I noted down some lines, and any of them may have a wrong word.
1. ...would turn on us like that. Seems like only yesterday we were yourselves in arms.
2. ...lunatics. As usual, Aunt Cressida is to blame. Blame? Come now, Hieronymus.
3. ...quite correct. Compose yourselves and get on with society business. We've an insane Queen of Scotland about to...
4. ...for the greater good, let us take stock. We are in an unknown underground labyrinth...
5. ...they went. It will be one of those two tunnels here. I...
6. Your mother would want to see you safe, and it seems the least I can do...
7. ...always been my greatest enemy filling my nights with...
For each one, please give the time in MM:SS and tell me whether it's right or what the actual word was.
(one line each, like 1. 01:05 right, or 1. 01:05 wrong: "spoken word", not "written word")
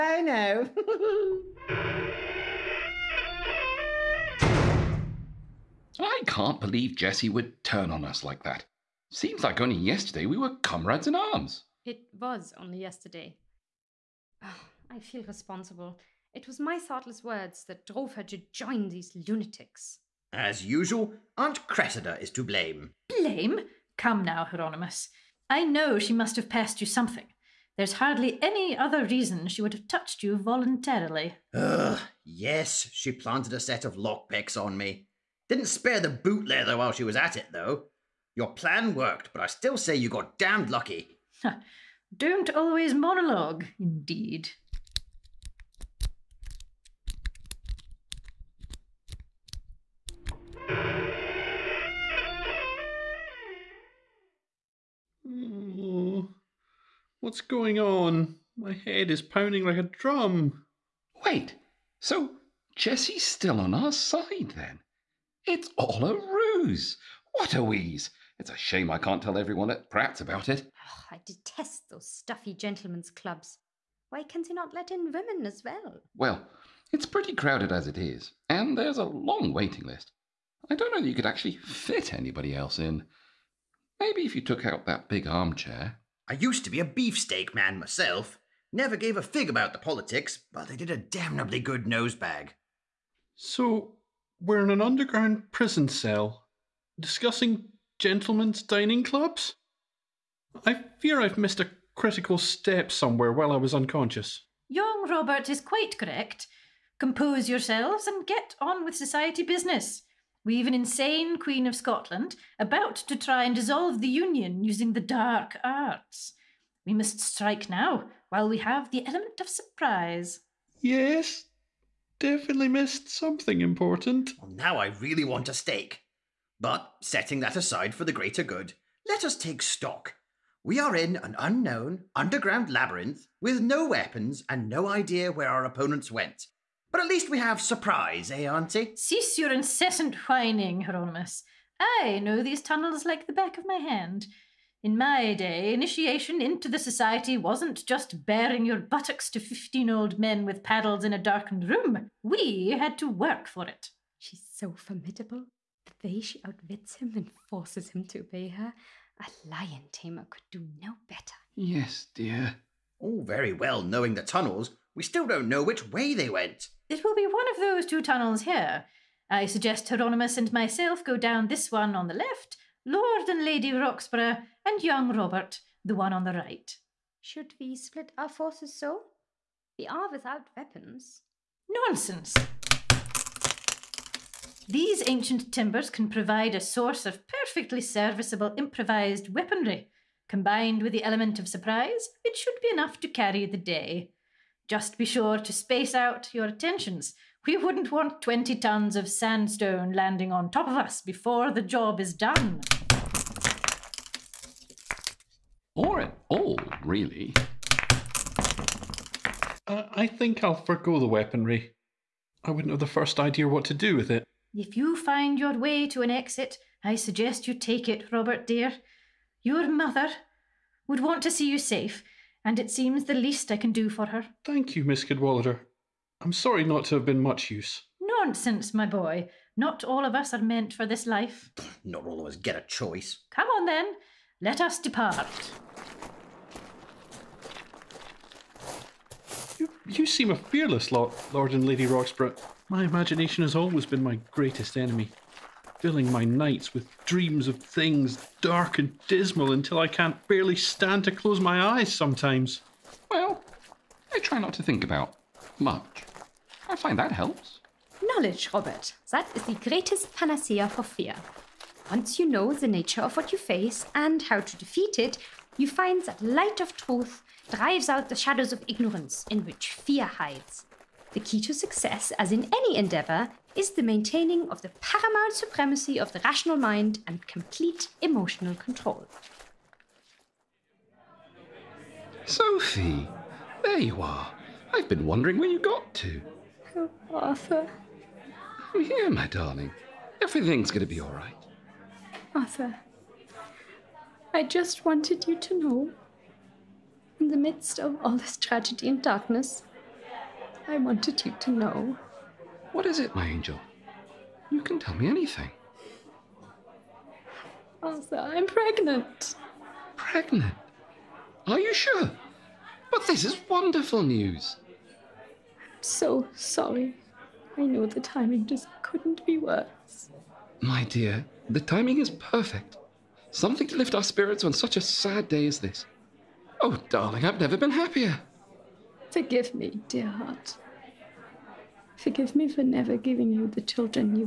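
1. 00:07 wrong: "comrades", not "yourselves"
2. 00:19 right
3. 01:45 right
4. 02:07 right
5. 02:46 right
6. 03:39 right
7. 04:03 right.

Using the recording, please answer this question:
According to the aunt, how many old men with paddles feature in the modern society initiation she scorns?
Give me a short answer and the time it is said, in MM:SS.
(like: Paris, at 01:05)
15, at 02:29.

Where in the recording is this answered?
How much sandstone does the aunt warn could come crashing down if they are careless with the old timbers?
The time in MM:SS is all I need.
03:18.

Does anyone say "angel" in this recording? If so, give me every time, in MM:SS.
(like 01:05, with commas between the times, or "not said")
05:03.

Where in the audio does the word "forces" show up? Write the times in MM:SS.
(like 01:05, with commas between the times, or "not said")
02:37, 02:58.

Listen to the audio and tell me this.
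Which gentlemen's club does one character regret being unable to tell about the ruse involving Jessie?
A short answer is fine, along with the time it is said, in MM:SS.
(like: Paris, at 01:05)
Pratt's, at 01:09.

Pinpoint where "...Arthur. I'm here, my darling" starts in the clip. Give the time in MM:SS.
04:47.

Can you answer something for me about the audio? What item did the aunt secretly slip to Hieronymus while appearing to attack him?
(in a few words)
Lockpicks.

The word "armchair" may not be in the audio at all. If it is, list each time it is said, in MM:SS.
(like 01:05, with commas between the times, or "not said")
01:25.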